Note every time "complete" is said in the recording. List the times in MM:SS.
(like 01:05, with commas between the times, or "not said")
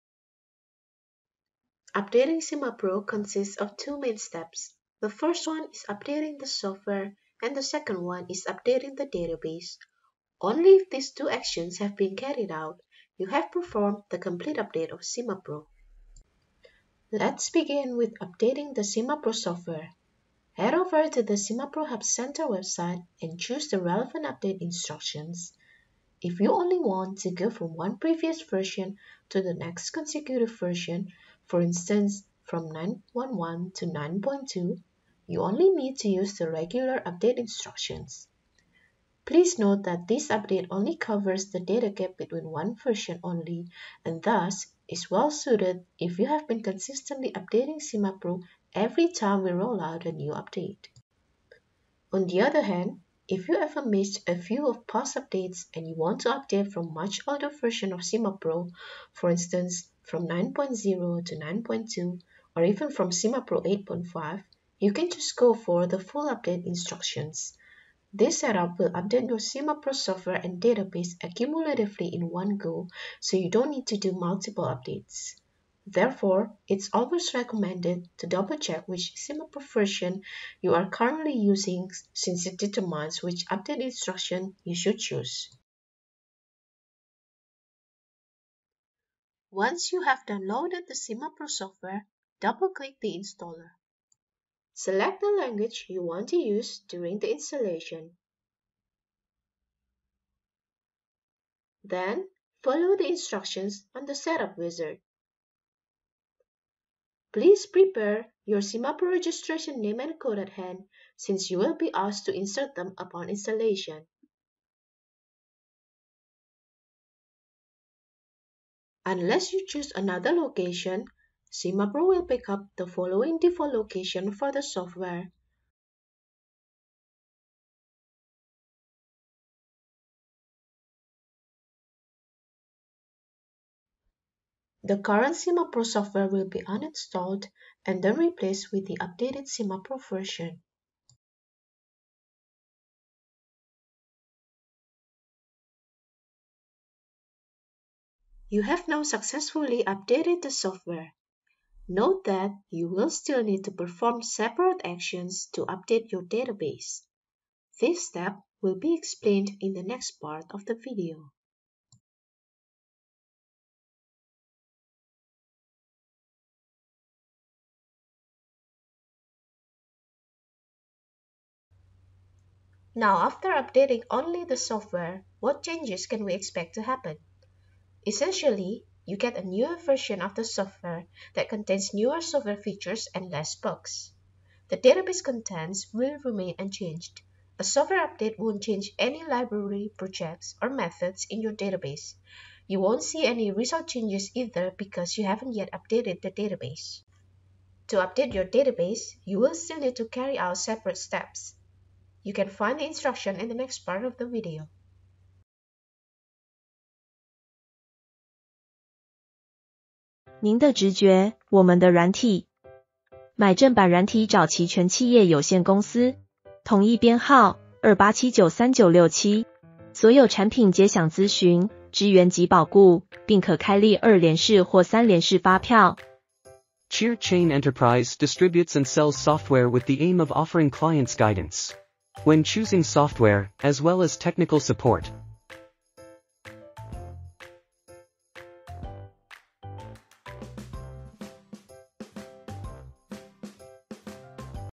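00:14.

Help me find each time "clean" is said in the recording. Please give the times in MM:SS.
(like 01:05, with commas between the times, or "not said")
not said.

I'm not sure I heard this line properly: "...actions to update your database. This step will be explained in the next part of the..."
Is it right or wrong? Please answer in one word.
right.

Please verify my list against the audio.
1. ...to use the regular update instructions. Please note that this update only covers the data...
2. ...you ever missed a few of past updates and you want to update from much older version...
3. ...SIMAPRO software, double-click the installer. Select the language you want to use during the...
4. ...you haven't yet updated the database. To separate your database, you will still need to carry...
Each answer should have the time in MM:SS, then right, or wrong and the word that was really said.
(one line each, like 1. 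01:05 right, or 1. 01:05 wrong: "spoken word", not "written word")
1. 00:35 right
2. 00:53 right
3. 01:30 right
4. 03:15 wrong: "update", not "separate".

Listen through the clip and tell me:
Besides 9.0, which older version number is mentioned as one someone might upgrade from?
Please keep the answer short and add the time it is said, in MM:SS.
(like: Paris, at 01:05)
SimaPro 8.5, at 01:03.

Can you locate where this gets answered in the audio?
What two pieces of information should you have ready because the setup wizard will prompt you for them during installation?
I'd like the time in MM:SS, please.
01:49.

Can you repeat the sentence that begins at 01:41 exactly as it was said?
Then, follow the instructions on the Setup Wizard.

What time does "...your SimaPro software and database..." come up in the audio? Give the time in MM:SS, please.
01:09.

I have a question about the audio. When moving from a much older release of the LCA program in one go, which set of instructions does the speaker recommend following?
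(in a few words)
full update instructions.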